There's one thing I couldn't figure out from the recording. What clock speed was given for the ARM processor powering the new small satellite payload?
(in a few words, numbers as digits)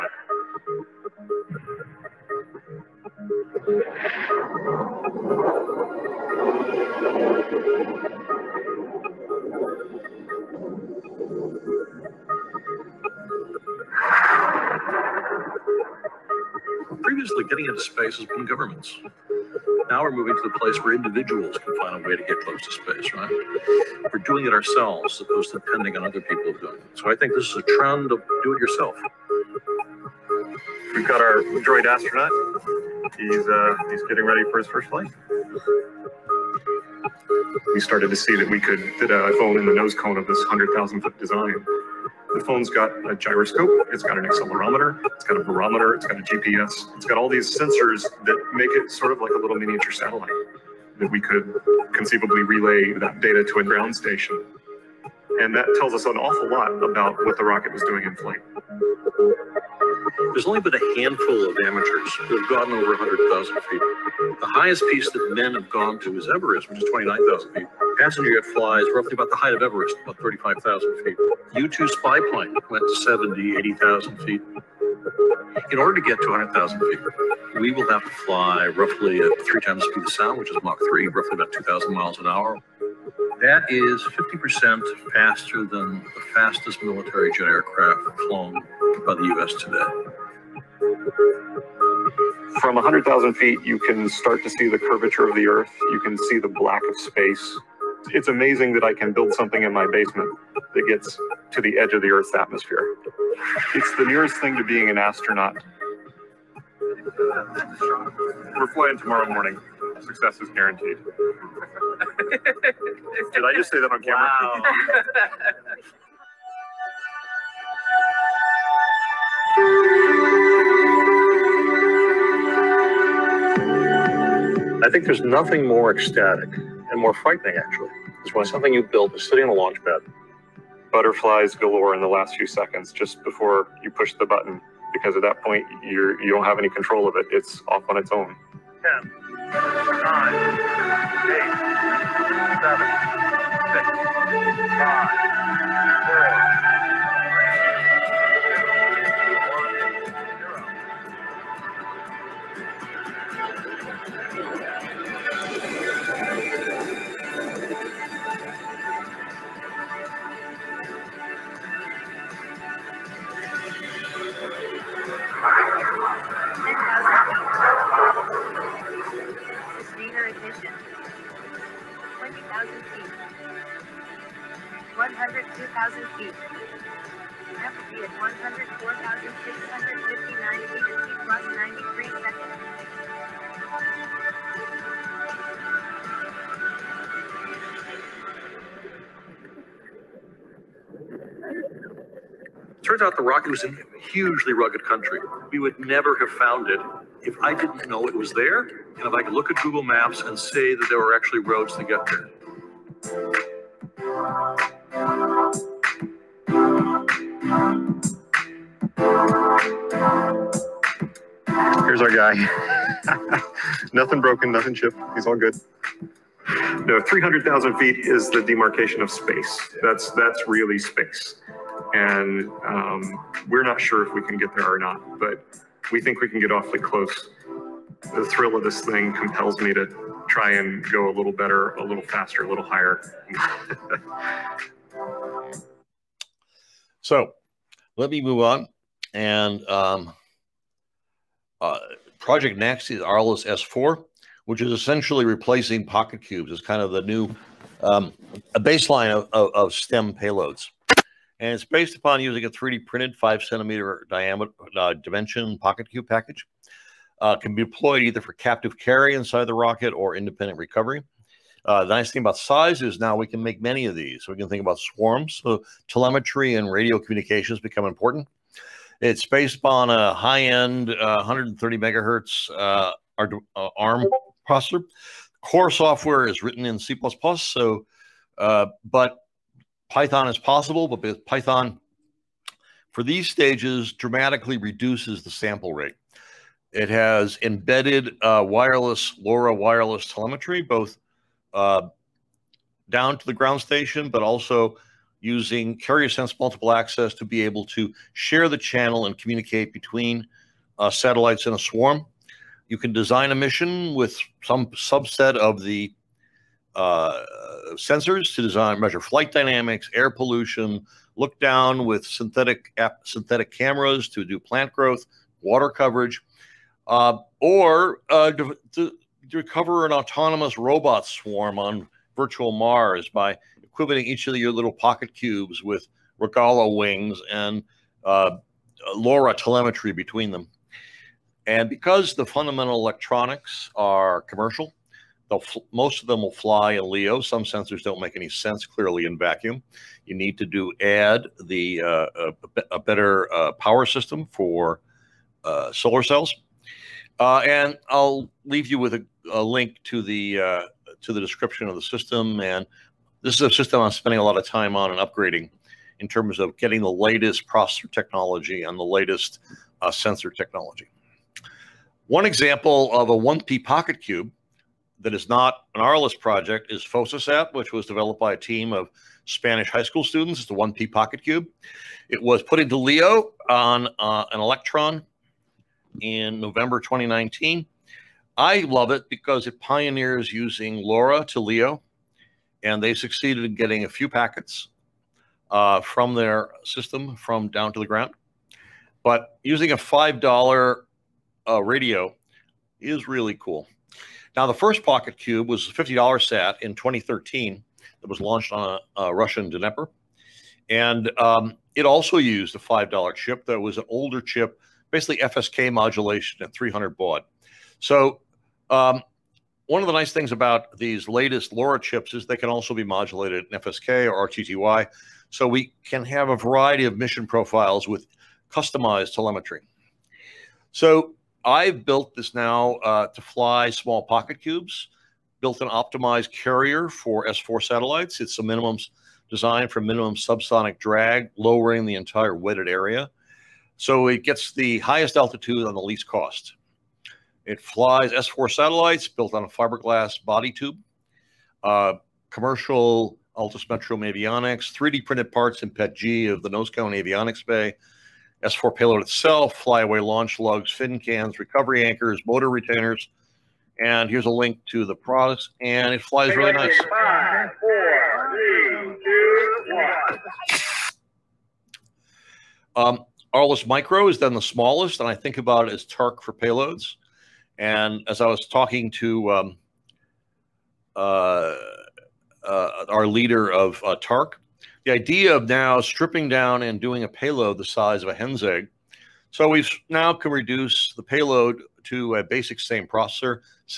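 130 megahertz.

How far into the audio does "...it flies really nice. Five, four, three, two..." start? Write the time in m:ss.
7:35.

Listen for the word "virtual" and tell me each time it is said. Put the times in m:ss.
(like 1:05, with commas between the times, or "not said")
5:22.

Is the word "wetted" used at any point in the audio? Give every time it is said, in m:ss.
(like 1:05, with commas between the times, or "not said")
7:12.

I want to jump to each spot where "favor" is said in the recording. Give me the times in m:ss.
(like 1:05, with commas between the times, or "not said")
not said.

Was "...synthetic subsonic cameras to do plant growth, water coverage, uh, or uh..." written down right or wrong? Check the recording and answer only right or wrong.
wrong.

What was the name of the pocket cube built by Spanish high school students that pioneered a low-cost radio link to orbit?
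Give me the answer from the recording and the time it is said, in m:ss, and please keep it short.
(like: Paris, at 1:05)
FossaSat, at 6:06.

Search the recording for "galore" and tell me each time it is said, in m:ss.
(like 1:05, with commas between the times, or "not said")
2:11.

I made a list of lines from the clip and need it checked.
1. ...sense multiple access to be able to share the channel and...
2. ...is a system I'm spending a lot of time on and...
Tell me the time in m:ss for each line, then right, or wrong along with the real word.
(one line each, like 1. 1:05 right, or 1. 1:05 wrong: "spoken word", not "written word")
1. 4:56 right
2. 5:53 right.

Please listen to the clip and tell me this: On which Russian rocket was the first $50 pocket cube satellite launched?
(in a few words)
Dnepr.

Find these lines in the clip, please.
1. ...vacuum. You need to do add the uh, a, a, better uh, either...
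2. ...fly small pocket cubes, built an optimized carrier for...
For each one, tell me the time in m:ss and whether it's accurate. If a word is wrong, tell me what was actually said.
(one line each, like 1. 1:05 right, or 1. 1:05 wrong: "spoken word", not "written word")
1. 5:39 wrong: "power", not "either"
2. 7:03 right.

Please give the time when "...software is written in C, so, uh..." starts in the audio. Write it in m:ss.
4:35.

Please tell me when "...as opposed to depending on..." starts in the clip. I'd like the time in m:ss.
0:25.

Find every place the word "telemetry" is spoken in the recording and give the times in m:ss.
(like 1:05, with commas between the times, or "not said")
4:25, 4:50, 5:29, 6:59.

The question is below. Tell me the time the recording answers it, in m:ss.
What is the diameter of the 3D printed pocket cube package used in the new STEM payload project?
4:13.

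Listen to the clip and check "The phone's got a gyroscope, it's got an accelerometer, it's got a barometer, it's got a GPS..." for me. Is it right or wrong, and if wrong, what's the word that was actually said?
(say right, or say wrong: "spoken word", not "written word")
right.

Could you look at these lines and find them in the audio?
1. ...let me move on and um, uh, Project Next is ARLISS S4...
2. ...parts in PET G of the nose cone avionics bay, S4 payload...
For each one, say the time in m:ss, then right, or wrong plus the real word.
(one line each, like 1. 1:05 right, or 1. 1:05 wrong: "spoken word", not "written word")
1. 3:57 right
2. 7:25 right.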